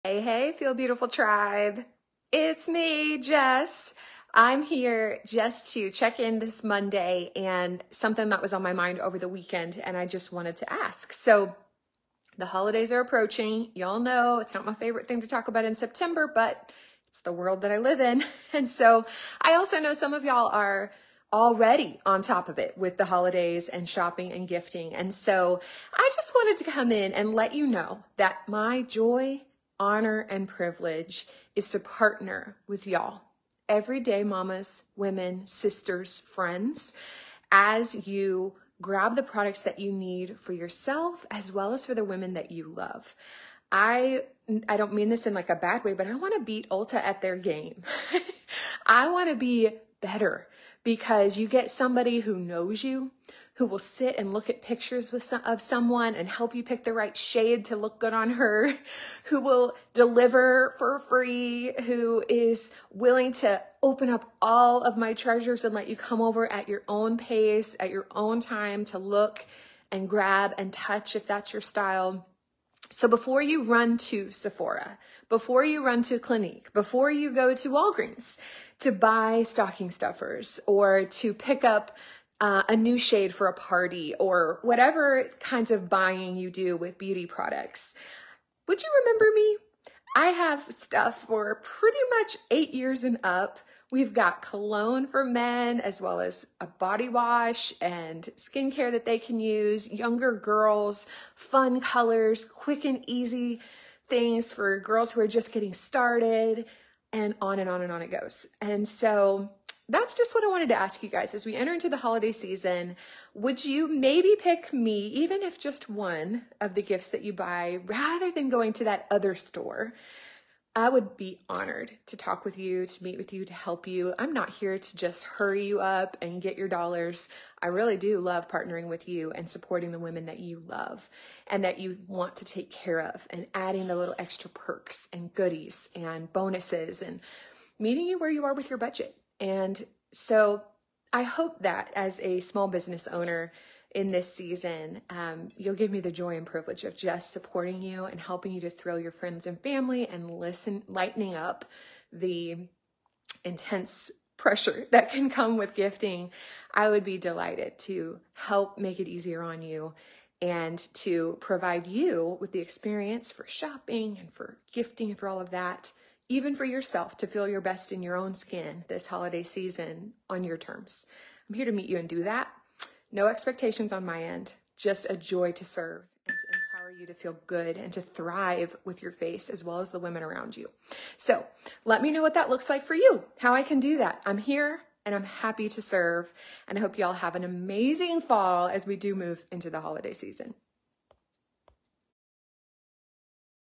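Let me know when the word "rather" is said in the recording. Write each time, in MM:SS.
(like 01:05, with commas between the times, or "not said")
01:57.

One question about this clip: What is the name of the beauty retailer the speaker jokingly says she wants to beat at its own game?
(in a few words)
Ulta.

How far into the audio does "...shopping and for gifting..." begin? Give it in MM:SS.
02:43.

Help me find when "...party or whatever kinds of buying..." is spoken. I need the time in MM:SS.
01:23.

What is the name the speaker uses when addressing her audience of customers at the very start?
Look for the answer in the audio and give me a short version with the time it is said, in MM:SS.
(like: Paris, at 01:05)
Feel Beautiful Tribe, at 00:00.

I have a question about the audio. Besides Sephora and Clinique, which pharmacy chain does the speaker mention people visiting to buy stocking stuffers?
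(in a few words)
Walgreens.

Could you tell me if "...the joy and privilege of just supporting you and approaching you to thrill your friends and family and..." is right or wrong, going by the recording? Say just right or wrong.
wrong.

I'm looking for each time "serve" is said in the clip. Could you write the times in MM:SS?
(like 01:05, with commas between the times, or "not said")
02:55, 03:05.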